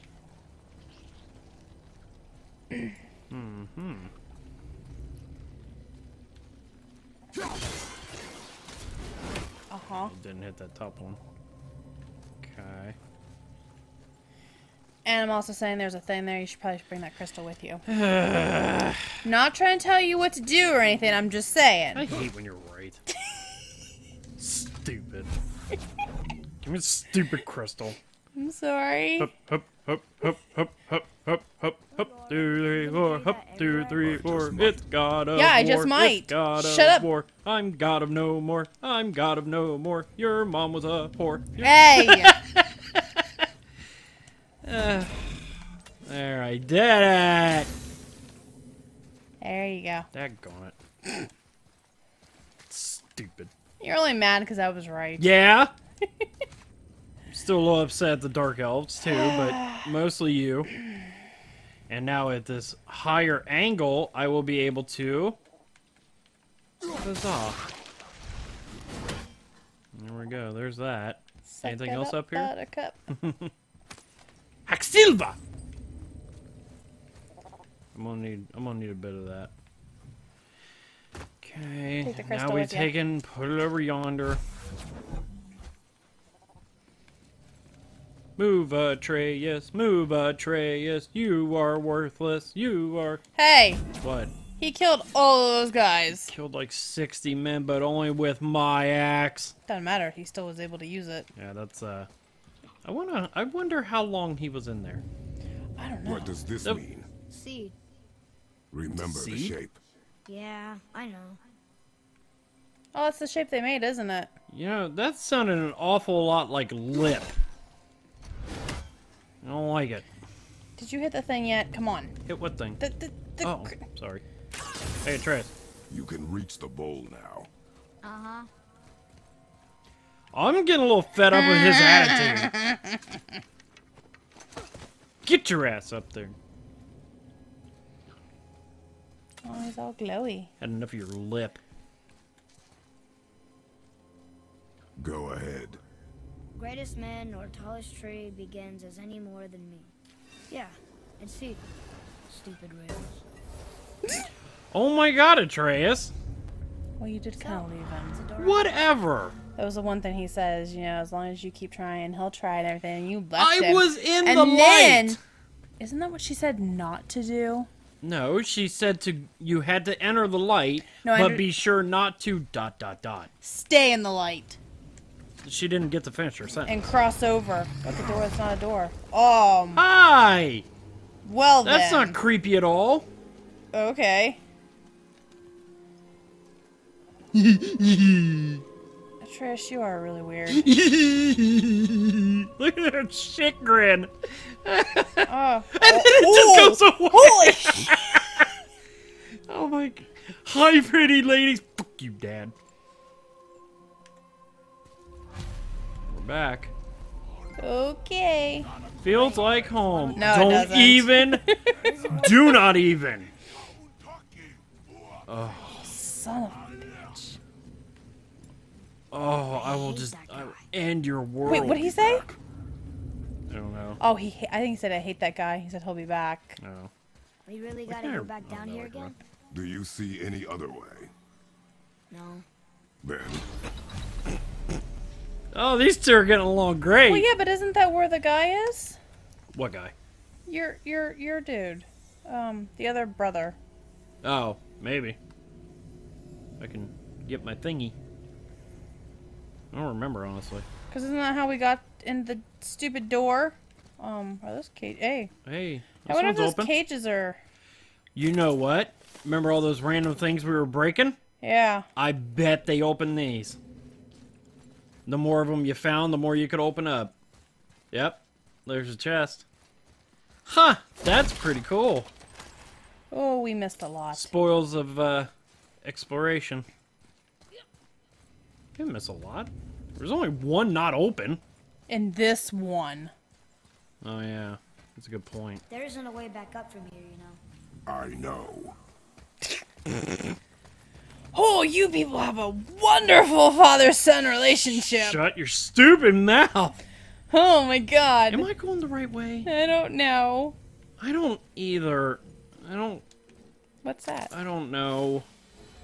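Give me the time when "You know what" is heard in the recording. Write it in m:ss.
4:18.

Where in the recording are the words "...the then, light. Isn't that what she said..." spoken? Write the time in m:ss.
2:44.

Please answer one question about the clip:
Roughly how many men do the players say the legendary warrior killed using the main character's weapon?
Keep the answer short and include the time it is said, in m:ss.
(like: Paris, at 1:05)
60, at 1:36.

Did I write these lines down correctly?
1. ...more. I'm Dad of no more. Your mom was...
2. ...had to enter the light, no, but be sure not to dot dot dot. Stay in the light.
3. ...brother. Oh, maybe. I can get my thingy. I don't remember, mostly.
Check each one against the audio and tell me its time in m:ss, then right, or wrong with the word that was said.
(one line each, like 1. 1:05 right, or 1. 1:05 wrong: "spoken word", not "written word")
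1. 0:38 wrong: "God", not "Dad"
2. 2:49 right
3. 4:03 wrong: "honestly", not "mostly".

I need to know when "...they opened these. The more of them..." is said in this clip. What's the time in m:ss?
4:22.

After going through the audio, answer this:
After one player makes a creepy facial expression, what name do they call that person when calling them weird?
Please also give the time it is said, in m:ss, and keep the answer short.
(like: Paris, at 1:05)
Trish, at 3:09.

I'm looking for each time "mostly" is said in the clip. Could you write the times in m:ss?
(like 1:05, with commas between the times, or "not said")
0:59.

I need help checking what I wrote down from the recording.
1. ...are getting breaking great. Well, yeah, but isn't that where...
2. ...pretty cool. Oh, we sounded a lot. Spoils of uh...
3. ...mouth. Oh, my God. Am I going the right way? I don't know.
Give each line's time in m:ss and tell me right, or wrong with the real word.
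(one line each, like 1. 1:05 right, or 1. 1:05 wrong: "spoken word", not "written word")
1. 3:56 wrong: "along", not "breaking"
2. 4:31 wrong: "missed", not "sounded"
3. 4:56 right.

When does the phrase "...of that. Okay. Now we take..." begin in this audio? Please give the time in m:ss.
1:19.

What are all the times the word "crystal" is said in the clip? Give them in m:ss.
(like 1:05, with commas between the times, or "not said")
0:17, 0:27.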